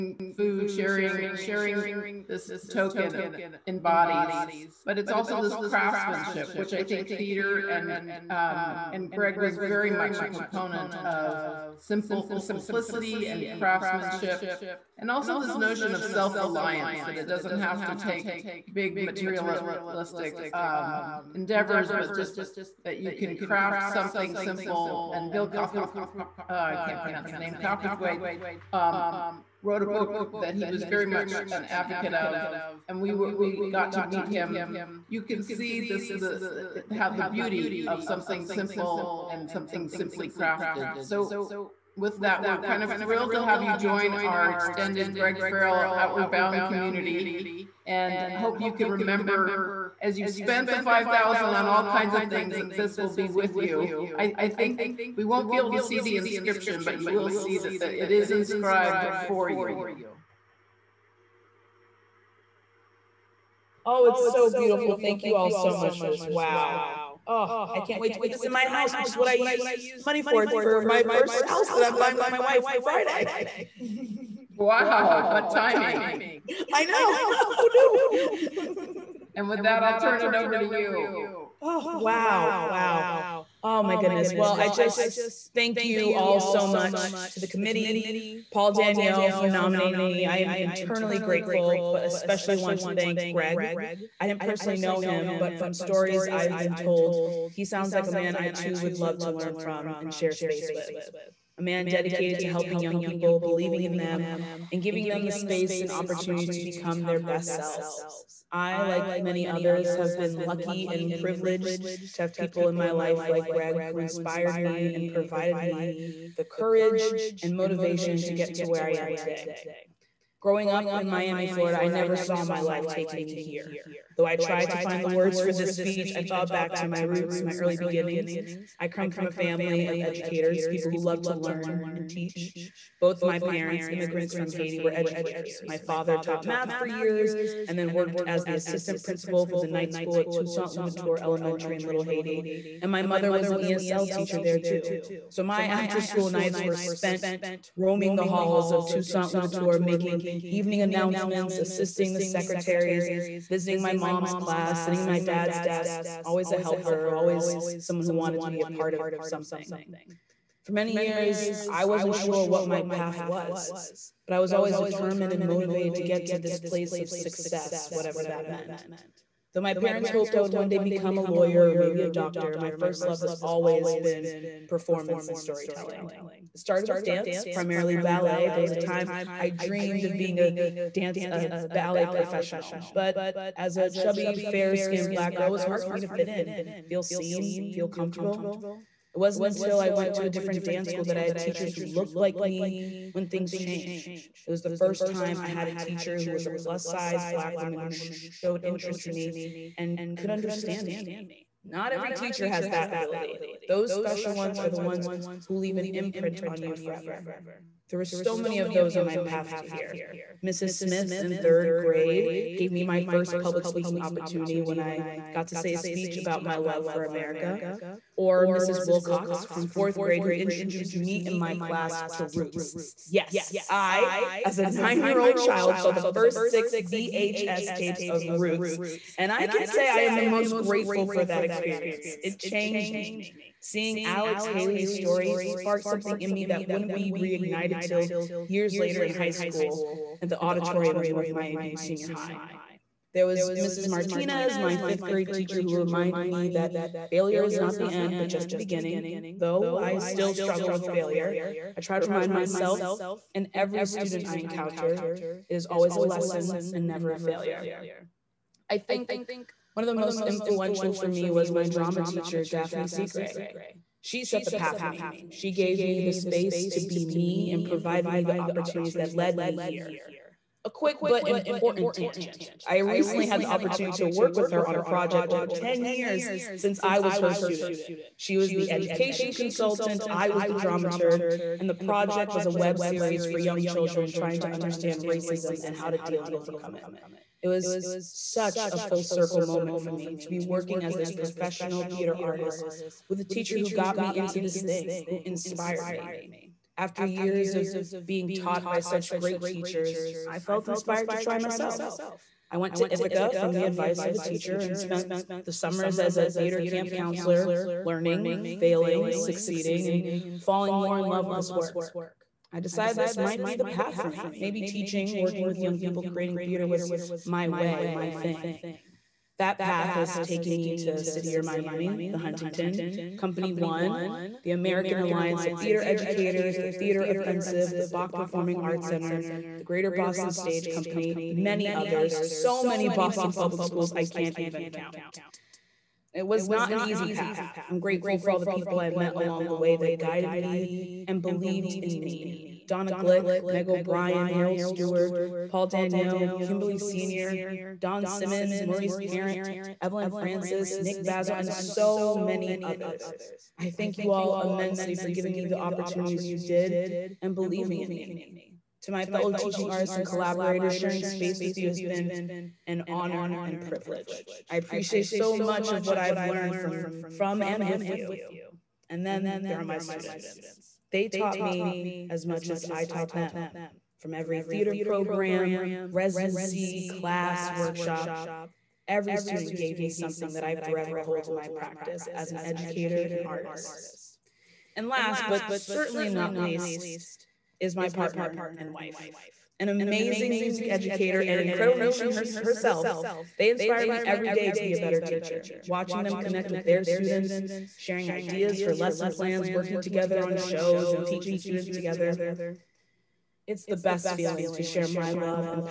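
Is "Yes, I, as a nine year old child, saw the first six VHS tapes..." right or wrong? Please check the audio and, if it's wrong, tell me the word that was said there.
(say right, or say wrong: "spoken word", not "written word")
right.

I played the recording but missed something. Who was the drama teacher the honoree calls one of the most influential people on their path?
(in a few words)
Daphne Segre.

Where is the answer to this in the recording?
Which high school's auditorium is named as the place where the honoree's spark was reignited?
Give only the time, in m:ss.
4:01.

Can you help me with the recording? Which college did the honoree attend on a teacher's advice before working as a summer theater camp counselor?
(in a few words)
Ithaca.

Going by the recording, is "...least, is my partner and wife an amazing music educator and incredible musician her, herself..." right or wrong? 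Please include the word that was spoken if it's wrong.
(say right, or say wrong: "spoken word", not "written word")
right.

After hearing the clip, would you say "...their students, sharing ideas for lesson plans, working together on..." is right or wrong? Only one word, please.
right.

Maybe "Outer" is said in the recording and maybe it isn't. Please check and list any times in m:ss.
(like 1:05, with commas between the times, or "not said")
not said.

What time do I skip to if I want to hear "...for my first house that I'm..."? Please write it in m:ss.
1:10.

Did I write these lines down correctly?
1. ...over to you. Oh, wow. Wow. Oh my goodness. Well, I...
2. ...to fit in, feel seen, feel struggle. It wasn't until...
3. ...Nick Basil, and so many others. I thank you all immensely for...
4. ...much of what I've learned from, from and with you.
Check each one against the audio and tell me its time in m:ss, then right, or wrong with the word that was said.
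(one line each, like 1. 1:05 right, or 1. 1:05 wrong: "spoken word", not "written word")
1. 1:20 right
2. 3:06 wrong: "comfortable", not "struggle"
3. 5:50 right
4. 6:05 right.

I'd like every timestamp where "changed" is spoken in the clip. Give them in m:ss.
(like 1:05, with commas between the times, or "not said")
3:13, 3:52.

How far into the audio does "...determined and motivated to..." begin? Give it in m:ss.
2:44.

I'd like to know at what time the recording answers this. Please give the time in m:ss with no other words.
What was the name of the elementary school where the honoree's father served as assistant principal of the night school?
2:20.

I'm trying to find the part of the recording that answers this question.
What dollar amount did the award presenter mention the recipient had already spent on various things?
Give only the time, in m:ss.
0:50.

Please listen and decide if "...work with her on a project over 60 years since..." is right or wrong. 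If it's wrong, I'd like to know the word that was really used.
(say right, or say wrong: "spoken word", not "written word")
wrong: "10", not "60".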